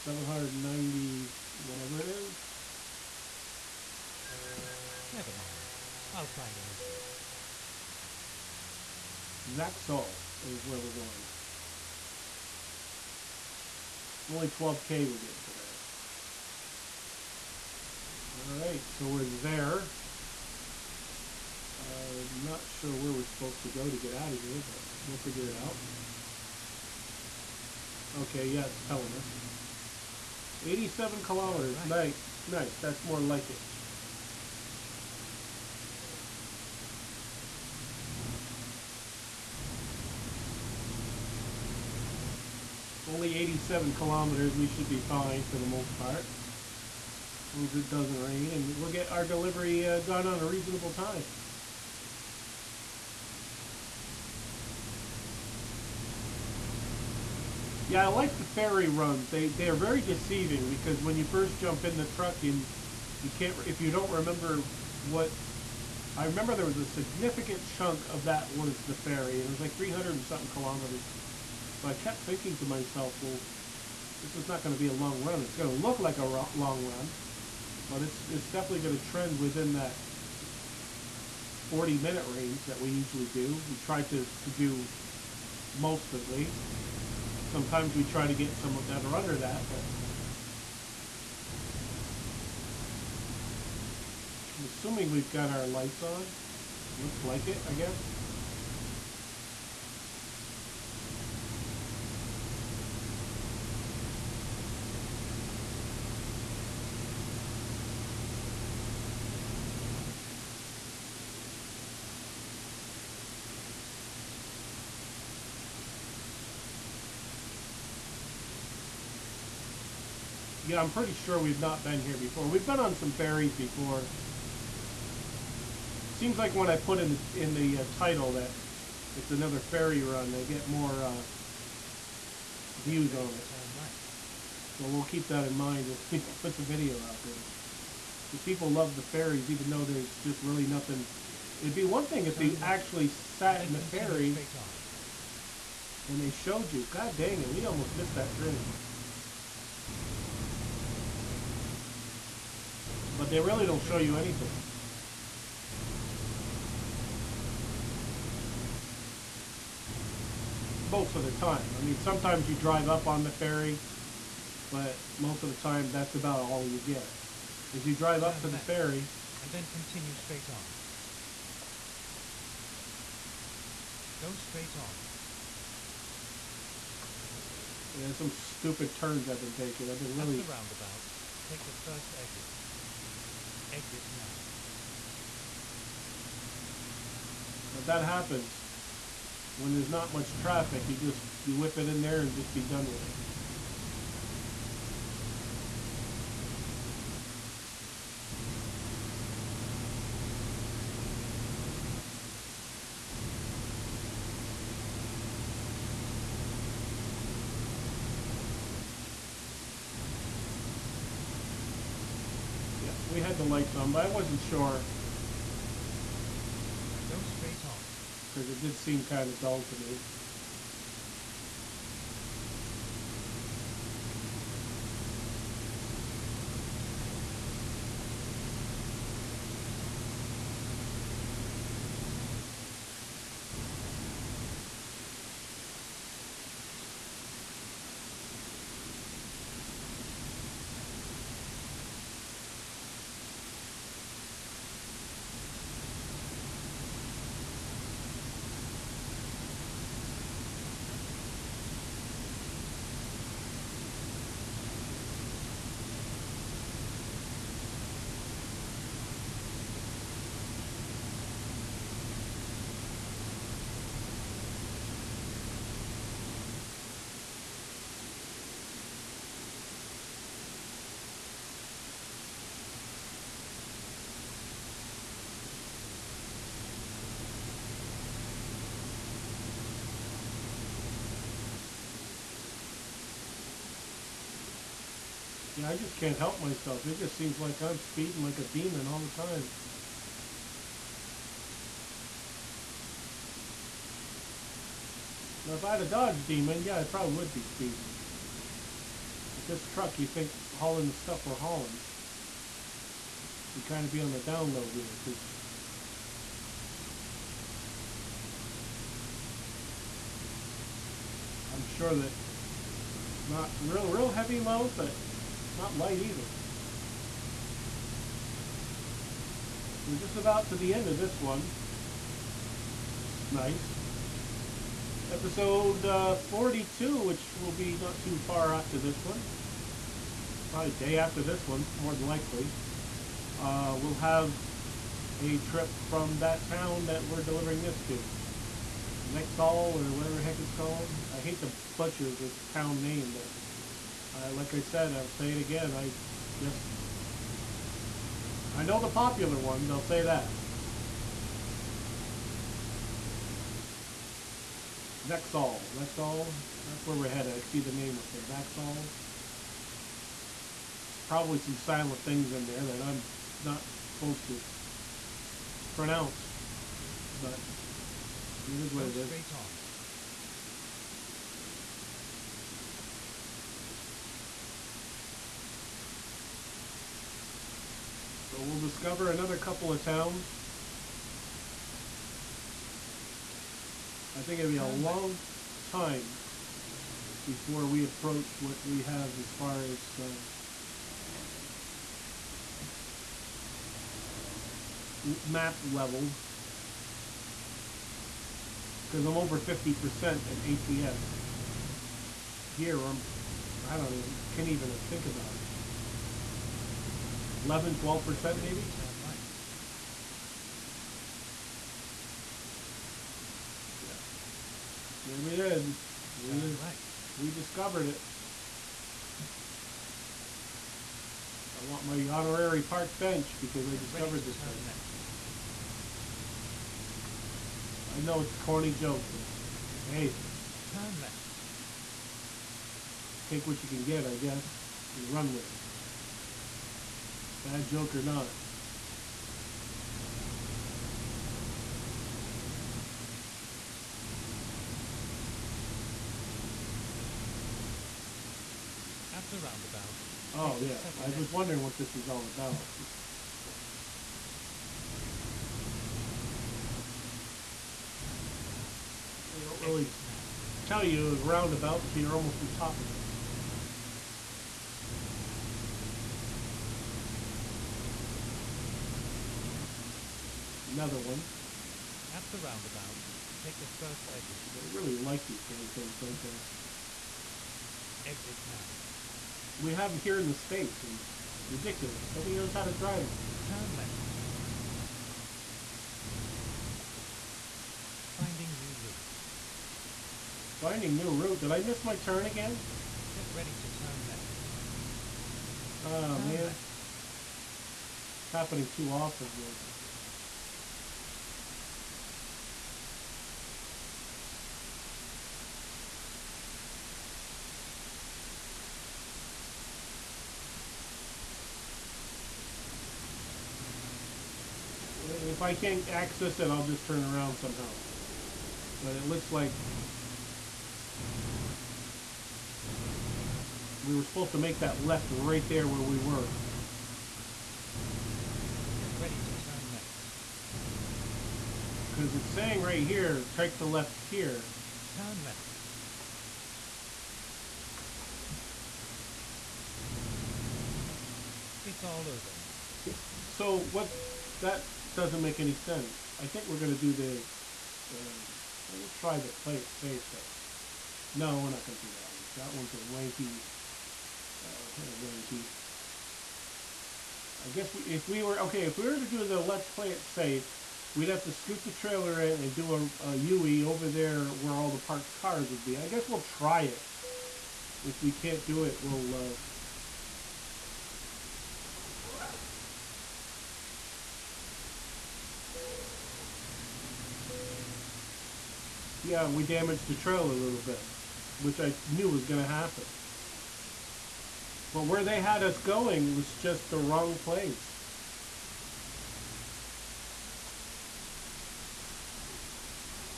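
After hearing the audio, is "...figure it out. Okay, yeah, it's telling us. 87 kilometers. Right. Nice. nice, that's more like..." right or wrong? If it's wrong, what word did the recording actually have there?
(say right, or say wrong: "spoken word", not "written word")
right.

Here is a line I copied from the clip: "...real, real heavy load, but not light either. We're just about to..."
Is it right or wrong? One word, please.
right.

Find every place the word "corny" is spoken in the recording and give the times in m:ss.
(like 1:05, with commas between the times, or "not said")
7:08.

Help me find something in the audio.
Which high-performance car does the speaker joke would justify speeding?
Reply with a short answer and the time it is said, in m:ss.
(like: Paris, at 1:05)
Dodge Demon, at 4:55.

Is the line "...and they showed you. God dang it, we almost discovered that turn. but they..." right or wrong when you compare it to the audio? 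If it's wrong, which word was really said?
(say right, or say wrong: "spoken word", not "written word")
wrong: "missed", not "discovered".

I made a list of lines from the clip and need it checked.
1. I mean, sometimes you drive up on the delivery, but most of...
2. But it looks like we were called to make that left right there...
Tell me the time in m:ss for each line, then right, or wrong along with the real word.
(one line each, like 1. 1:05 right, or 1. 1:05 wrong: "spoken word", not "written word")
1. 2:41 wrong: "ferry", not "delivery"
2. 8:38 wrong: "supposed", not "called".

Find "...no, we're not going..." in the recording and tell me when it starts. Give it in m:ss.
9:11.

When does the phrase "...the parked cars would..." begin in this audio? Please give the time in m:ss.
9:24.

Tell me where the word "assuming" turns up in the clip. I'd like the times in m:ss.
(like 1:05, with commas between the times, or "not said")
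1:34.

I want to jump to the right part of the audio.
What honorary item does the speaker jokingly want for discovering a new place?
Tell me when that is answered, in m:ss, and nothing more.
7:02.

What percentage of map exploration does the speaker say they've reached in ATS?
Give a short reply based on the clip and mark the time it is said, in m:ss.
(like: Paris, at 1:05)
over 50%, at 6:39.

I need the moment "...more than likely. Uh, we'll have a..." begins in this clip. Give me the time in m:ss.
5:31.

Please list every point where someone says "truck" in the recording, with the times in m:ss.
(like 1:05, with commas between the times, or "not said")
1:02, 4:59.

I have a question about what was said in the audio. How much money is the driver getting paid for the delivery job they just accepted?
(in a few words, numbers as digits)
12k.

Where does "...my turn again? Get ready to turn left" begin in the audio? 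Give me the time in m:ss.
8:11.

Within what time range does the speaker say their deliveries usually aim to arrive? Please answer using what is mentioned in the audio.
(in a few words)
40 minute.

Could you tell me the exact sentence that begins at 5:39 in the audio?
Hall or whatever heck it's called.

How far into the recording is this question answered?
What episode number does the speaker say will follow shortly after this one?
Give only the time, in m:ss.
5:26.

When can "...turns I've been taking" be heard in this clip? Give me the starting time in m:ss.
2:58.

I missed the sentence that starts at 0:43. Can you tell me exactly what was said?
Only 87 kilometers, we should be fine for the most part.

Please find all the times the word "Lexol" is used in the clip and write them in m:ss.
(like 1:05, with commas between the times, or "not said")
5:55.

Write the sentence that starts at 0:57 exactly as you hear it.
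Yeah, I like the ferry runs.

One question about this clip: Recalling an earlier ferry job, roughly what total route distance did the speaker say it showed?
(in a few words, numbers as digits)
300 and something kilometers.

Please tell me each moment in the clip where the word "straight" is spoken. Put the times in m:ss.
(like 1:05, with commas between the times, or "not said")
2:50, 2:54, 3:37, 6:09.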